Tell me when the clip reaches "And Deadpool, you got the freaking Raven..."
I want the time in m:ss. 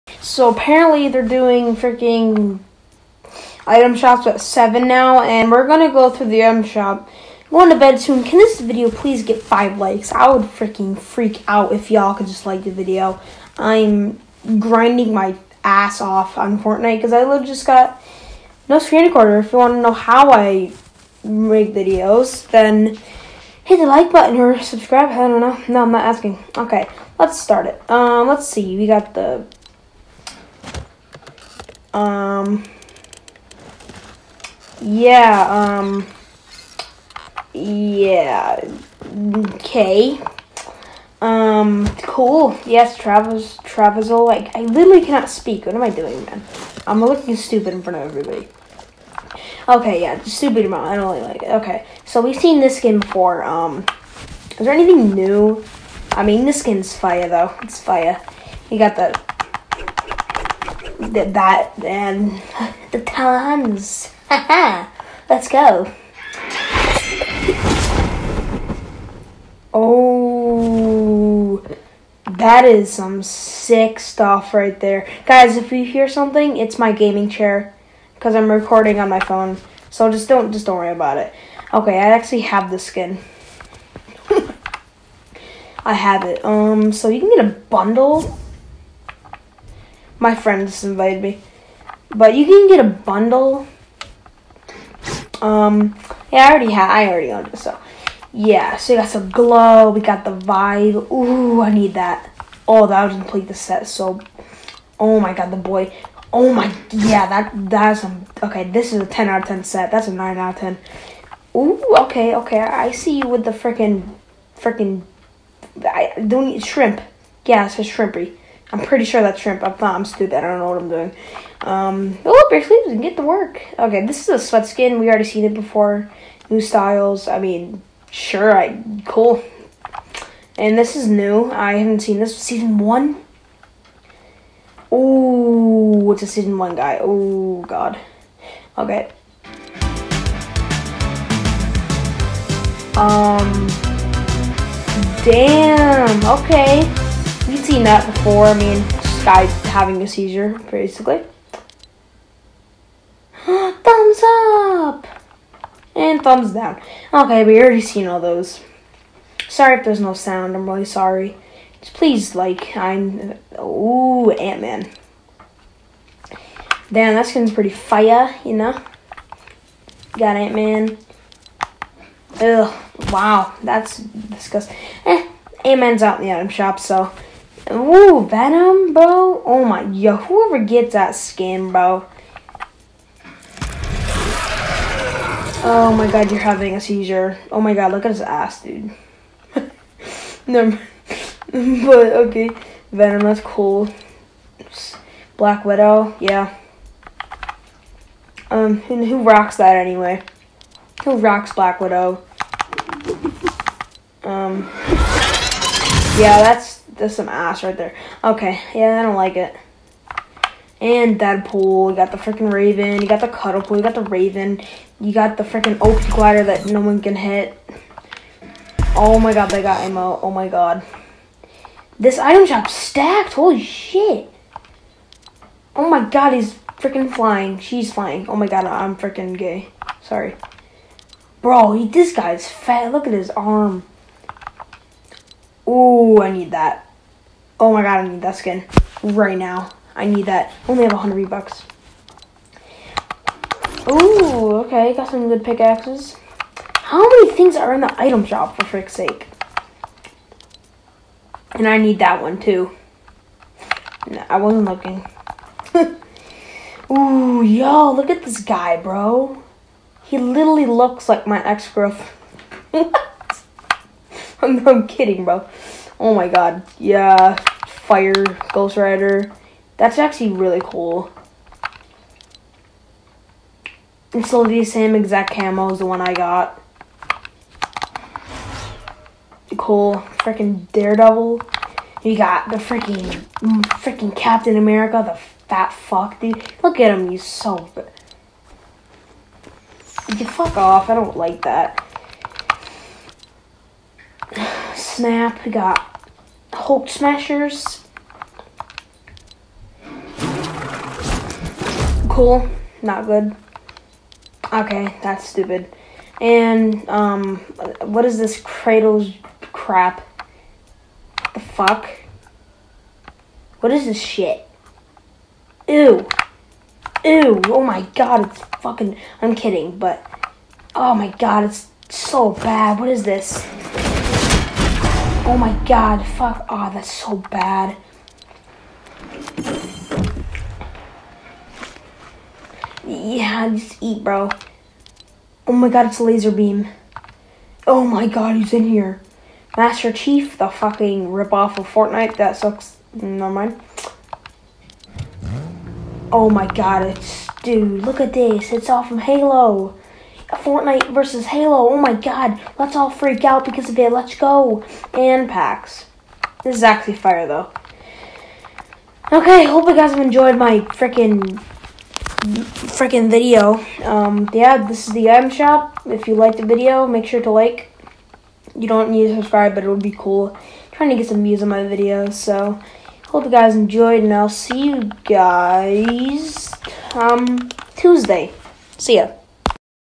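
3:30.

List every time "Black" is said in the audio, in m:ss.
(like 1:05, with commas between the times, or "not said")
3:15, 3:21.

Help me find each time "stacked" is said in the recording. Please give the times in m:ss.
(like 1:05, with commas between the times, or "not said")
3:42.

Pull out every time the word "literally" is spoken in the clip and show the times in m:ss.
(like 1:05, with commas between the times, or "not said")
0:44, 4:20.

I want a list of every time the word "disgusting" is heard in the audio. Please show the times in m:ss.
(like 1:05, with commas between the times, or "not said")
2:53.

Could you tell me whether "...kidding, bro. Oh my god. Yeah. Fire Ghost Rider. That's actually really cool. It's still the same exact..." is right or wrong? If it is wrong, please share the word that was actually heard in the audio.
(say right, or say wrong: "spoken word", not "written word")
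right.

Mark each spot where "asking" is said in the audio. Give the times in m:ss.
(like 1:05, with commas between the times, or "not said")
0:26.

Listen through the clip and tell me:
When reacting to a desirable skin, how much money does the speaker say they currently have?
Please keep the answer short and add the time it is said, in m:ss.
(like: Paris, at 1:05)
100 bucks, at 4:00.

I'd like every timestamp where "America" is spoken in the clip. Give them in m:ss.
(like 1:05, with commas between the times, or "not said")
4:44.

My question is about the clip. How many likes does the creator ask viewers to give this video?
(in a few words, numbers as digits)
5.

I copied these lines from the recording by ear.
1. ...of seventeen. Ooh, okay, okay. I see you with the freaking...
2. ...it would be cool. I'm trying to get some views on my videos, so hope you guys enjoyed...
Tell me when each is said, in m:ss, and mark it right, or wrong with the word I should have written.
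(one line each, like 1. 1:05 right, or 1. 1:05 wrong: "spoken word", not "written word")
1. 1:50 wrong: "ten", not "seventeen"
2. 6:09 right.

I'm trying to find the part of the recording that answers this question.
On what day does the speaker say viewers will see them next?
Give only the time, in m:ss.
6:17.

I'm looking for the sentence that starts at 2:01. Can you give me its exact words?
Um, oh, bare sleeves and get to work.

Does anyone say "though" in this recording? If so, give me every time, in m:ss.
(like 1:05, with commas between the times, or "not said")
0:57, 5:57.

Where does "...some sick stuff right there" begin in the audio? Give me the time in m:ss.
1:12.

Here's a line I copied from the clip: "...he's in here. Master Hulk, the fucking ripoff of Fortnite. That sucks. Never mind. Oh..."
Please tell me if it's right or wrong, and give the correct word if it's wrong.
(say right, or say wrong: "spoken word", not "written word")
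wrong: "Chief", not "Hulk".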